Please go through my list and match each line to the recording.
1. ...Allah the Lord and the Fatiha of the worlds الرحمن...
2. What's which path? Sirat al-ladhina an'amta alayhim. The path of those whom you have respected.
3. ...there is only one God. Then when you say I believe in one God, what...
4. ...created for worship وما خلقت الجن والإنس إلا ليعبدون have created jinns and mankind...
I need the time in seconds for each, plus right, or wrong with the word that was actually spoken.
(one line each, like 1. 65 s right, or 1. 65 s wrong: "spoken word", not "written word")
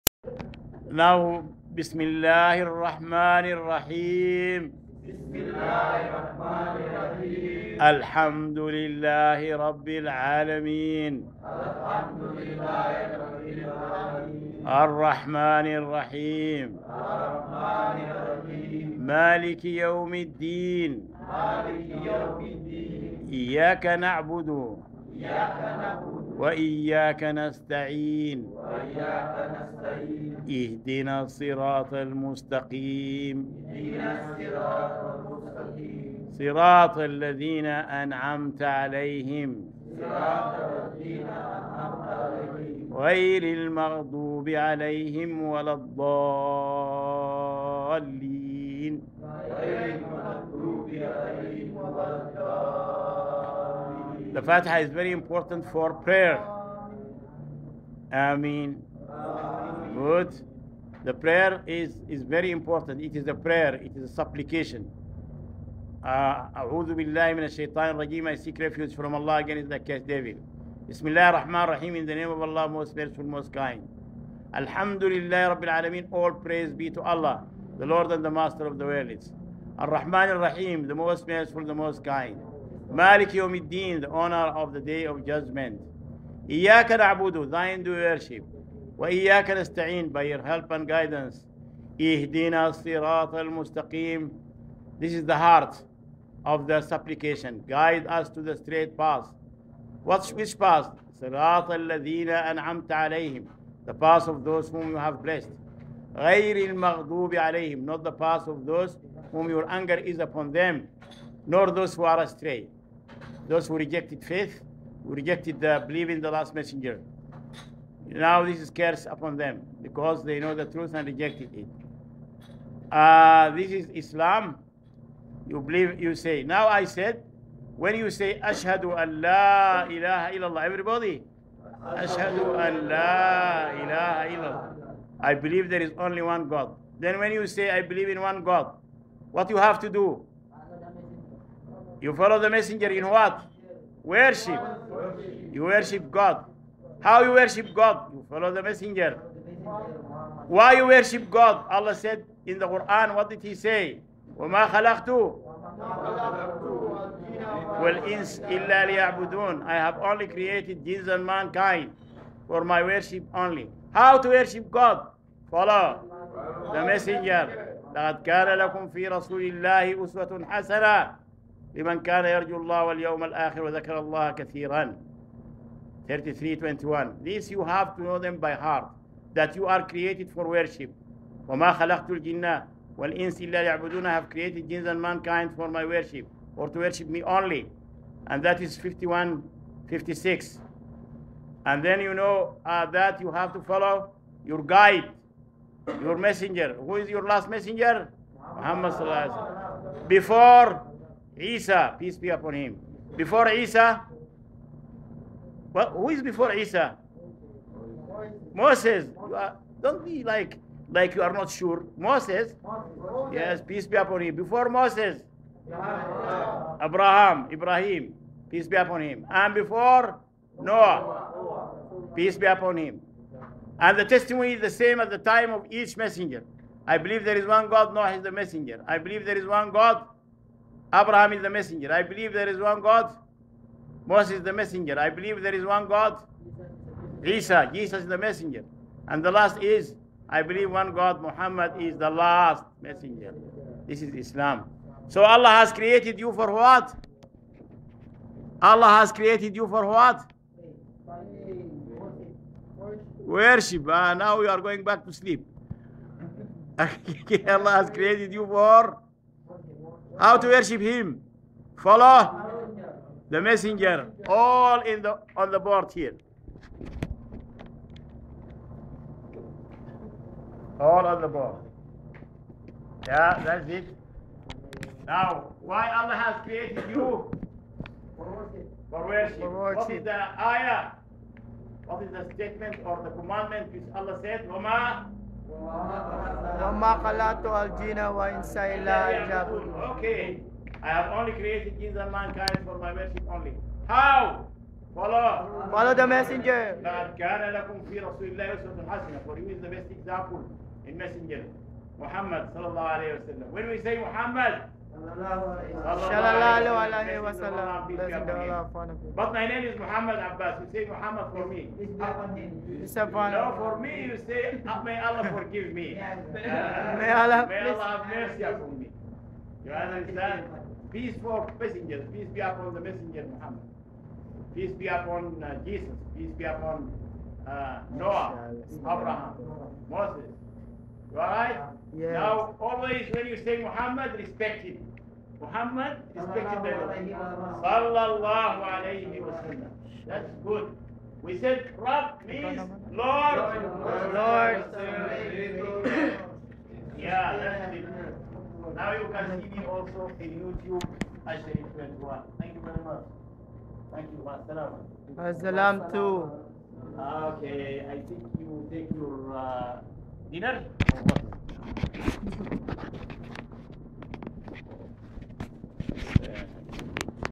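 1. 77 s wrong: "Master", not "Fatiha"
2. 100 s wrong: "blessed", not "respected"
3. 135 s right
4. 179 s right.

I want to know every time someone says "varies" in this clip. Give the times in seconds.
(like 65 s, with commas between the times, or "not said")
not said.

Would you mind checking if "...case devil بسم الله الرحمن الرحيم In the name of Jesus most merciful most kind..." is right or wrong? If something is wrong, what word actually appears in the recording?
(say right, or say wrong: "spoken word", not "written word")
wrong: "Allah", not "Jesus".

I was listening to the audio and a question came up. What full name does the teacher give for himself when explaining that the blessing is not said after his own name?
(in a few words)
Muhammad Abbas.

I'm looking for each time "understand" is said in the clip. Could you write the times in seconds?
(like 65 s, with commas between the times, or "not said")
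319 s.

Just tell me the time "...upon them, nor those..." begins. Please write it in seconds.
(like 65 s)
110 s.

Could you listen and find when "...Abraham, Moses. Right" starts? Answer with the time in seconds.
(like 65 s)
328 s.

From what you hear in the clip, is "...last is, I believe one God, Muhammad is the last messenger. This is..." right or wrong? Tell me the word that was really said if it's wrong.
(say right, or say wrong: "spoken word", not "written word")
right.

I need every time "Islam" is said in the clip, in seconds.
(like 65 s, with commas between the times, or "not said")
123 s, 244 s.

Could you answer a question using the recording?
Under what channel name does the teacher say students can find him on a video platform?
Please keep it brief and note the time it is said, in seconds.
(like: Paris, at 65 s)
Ashraf 21, at 351 s.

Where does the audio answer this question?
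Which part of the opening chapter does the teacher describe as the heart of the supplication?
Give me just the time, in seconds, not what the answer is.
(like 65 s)
91 s.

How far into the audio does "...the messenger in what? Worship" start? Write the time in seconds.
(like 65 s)
142 s.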